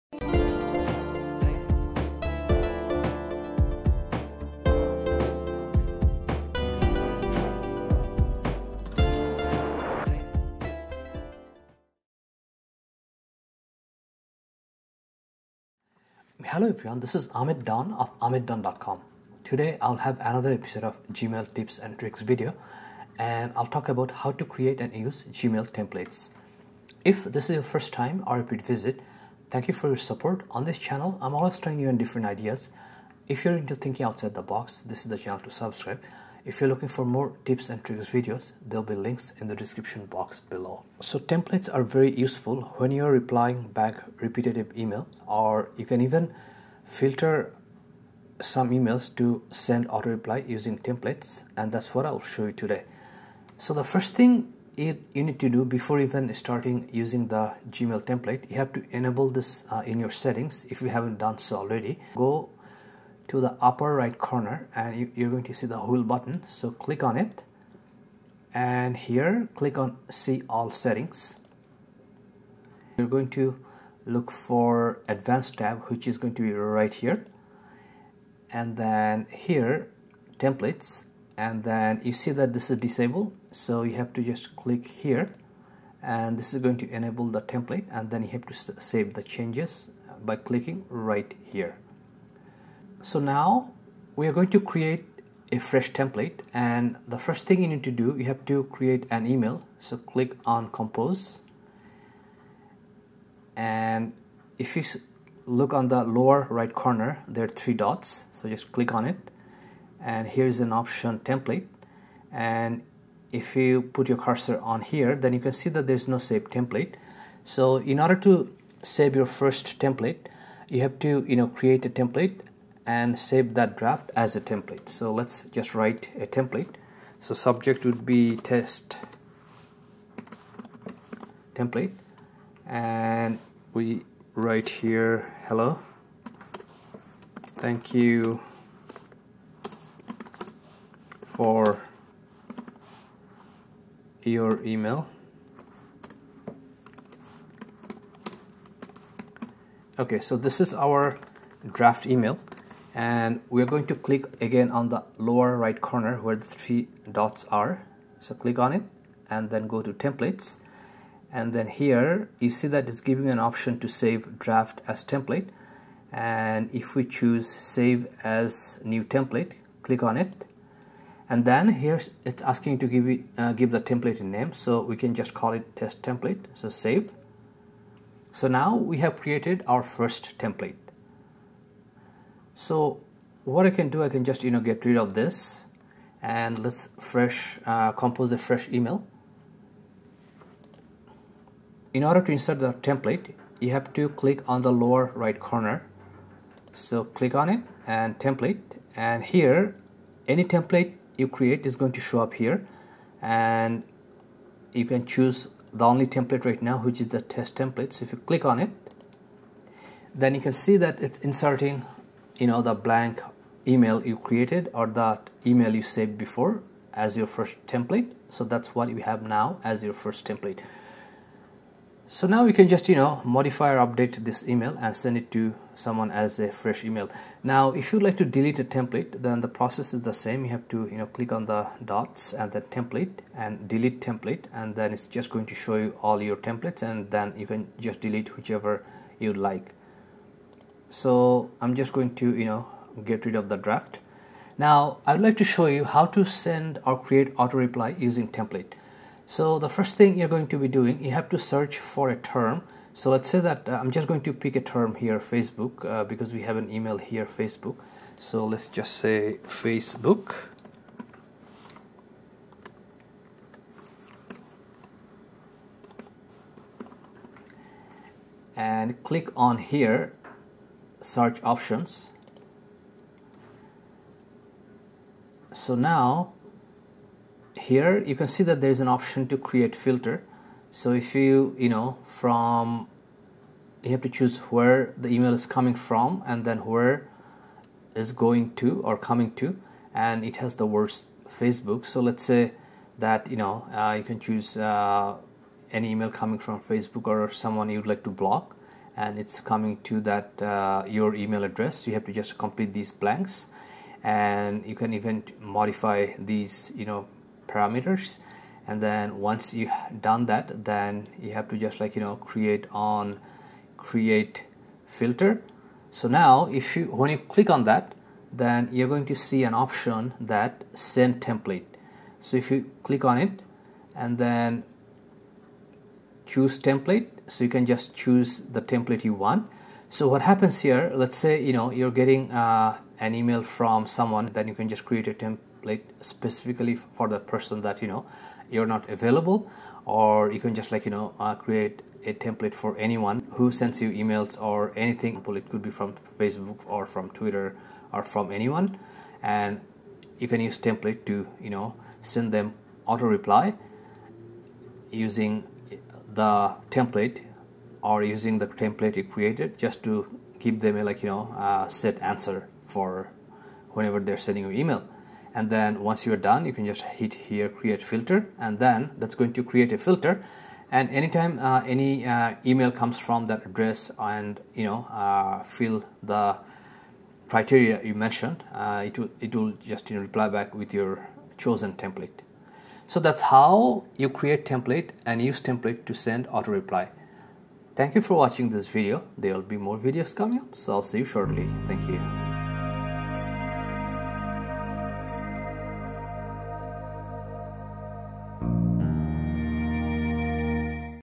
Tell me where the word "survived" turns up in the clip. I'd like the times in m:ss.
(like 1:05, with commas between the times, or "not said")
not said.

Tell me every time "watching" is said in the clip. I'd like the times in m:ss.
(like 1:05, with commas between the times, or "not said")
6:28.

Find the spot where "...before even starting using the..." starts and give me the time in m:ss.
0:55.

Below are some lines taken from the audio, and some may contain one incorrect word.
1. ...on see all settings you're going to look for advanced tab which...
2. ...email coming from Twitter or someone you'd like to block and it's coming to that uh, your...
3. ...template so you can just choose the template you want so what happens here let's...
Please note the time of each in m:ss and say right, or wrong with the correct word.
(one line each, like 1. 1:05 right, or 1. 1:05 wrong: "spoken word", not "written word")
1. 1:09 right
2. 4:55 wrong: "Facebook", not "Twitter"
3. 5:26 right.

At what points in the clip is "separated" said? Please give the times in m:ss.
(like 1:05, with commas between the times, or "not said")
not said.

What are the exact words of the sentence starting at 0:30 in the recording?
On this channel, I'm always trying you and different ideas.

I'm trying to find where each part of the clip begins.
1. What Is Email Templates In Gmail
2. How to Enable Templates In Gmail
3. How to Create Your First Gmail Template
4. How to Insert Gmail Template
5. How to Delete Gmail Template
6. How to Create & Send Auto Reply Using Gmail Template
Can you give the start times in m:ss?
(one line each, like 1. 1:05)
1. 0:15
2. 0:50
3. 1:30
4. 3:00
5. 3:45
6. 4:10.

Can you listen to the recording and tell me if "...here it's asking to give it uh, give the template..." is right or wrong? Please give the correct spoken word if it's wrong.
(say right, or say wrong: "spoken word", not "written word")
right.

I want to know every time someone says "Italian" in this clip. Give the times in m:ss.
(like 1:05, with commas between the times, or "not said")
not said.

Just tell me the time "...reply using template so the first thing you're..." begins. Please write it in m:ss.
4:07.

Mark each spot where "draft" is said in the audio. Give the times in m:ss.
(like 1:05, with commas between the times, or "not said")
2:03, 2:31, 2:44, 4:03.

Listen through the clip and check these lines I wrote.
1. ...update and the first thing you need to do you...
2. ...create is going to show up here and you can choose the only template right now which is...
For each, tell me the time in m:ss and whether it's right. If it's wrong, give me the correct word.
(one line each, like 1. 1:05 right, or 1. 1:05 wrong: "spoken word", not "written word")
1. 1:35 wrong: "template", not "update"
2. 3:21 right.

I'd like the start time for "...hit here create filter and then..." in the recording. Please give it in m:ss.
6:06.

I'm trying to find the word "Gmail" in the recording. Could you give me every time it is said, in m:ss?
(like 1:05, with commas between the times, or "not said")
0:21, 0:25, 0:57.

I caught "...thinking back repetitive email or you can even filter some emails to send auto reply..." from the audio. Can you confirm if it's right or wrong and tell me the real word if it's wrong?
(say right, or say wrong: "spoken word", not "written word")
wrong: "replying", not "thinking".